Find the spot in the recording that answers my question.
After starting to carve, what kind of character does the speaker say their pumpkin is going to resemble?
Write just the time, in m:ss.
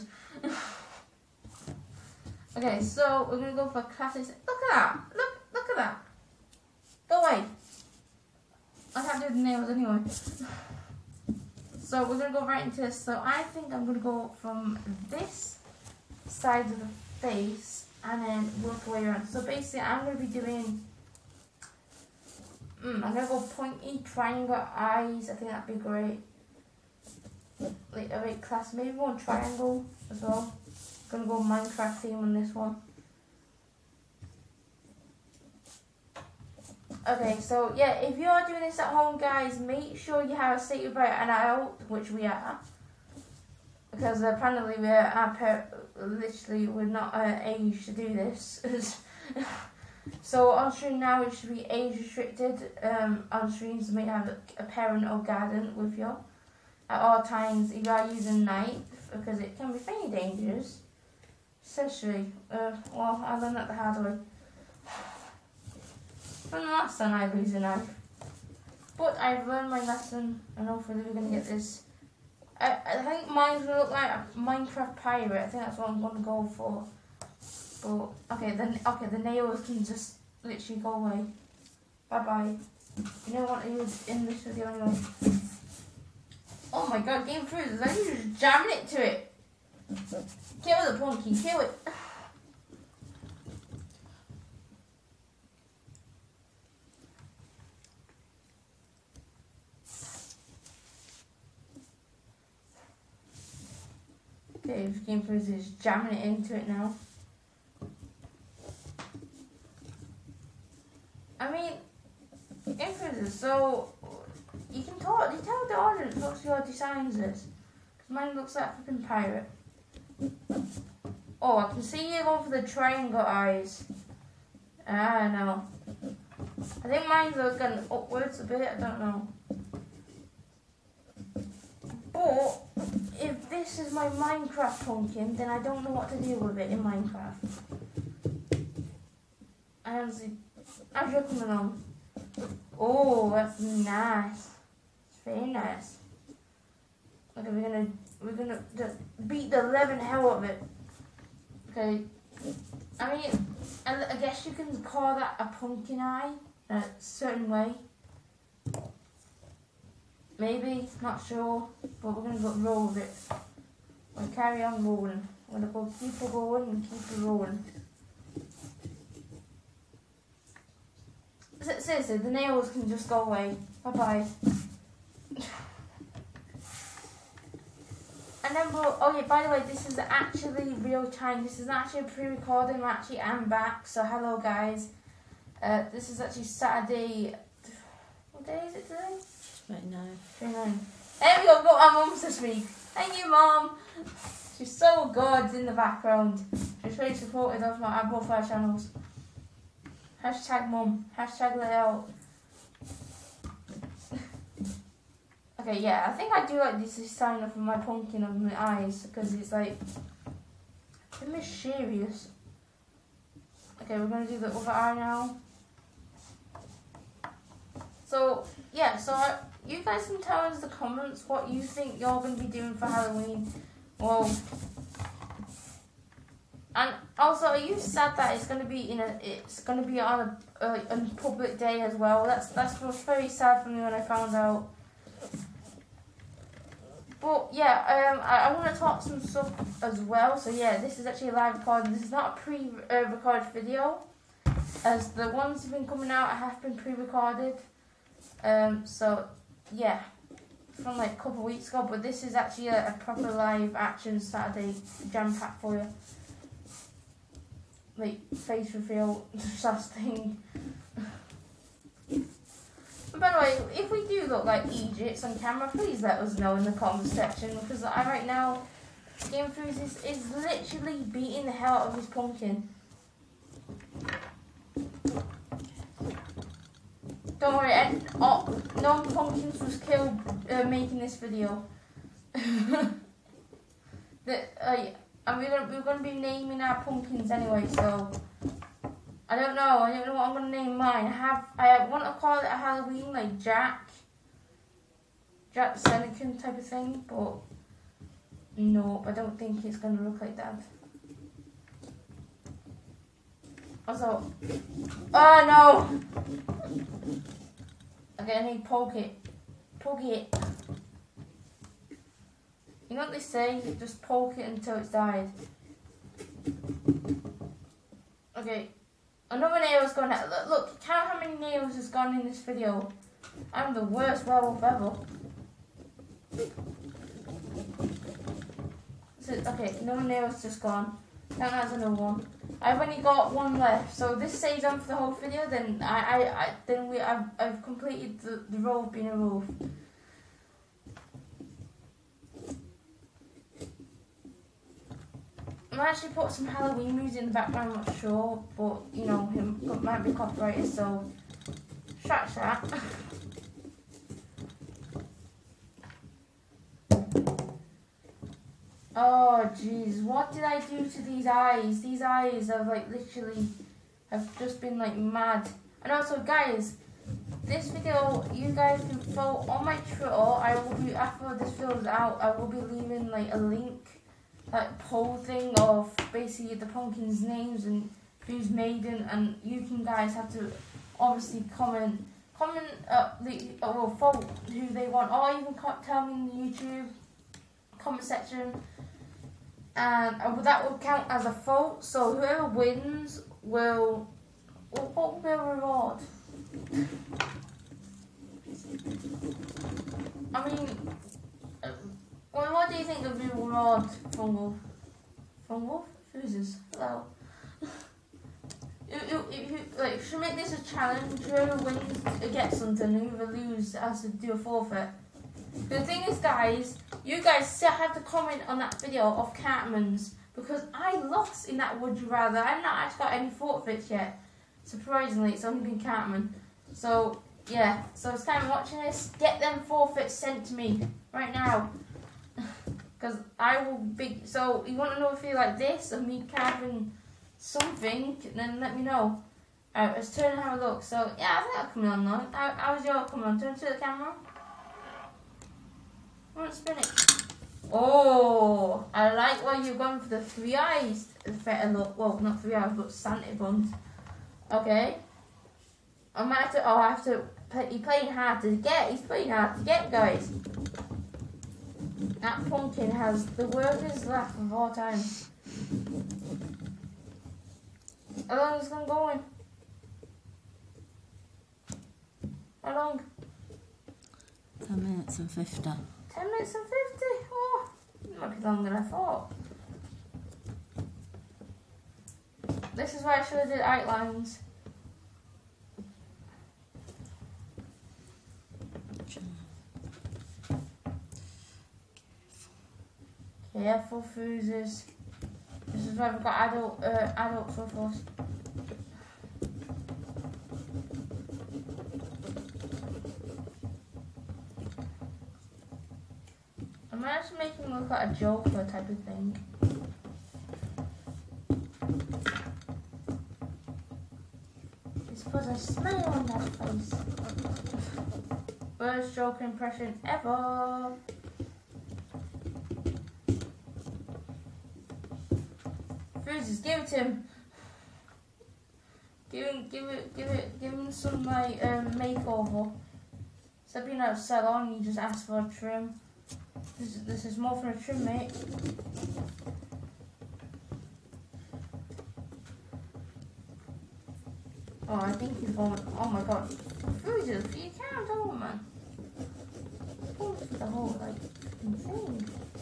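1:14.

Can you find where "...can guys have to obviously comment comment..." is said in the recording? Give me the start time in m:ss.
6:19.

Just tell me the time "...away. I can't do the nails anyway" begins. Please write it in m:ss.
0:07.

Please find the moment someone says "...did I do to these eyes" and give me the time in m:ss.
6:00.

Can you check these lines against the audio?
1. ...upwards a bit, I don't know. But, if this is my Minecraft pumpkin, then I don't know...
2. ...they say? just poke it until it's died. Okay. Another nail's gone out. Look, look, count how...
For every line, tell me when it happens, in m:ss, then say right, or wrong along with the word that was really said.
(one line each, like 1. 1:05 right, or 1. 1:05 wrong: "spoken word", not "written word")
1. 2:07 right
2. 5:13 right.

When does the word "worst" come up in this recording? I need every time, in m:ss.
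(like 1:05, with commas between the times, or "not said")
5:23, 8:38.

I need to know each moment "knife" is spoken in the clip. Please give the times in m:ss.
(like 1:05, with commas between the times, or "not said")
0:58, 1:07.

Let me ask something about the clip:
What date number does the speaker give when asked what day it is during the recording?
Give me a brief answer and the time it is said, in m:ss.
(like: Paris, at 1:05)
29, at 3:09.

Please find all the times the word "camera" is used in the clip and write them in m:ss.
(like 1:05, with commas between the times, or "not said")
4:25, 7:23.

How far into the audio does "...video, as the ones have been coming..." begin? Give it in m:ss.
4:03.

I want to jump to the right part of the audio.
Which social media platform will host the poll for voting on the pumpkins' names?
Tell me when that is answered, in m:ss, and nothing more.
6:09.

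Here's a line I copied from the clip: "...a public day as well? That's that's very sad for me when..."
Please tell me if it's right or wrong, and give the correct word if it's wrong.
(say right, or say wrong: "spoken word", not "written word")
right.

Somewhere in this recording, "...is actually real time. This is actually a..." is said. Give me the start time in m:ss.
2:59.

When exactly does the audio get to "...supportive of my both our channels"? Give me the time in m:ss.
3:17.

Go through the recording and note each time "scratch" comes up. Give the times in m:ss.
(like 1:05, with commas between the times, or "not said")
5:52.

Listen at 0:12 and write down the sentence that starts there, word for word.
So I think I'm gonna go from this side of the face and then work the way around.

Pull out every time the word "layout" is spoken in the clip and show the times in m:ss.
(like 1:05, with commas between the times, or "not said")
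3:21.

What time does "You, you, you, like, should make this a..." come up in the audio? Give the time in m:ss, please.
6:48.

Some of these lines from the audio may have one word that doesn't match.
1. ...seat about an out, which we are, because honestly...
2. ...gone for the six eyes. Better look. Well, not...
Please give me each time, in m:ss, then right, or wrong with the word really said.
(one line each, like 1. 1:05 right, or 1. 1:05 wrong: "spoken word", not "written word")
1. 0:40 wrong: "apparently", not "honestly"
2. 7:29 wrong: "three", not "six".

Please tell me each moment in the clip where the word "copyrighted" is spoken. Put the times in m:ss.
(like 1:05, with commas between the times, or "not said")
5:50.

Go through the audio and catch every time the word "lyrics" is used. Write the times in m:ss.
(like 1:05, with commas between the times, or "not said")
not said.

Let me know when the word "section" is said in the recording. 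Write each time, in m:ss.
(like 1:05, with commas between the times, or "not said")
4:27, 6:28.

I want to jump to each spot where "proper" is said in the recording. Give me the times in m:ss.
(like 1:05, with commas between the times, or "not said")
4:13.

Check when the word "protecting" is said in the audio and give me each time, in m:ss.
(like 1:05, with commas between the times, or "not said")
not said.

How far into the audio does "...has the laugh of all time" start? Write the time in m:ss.
7:42.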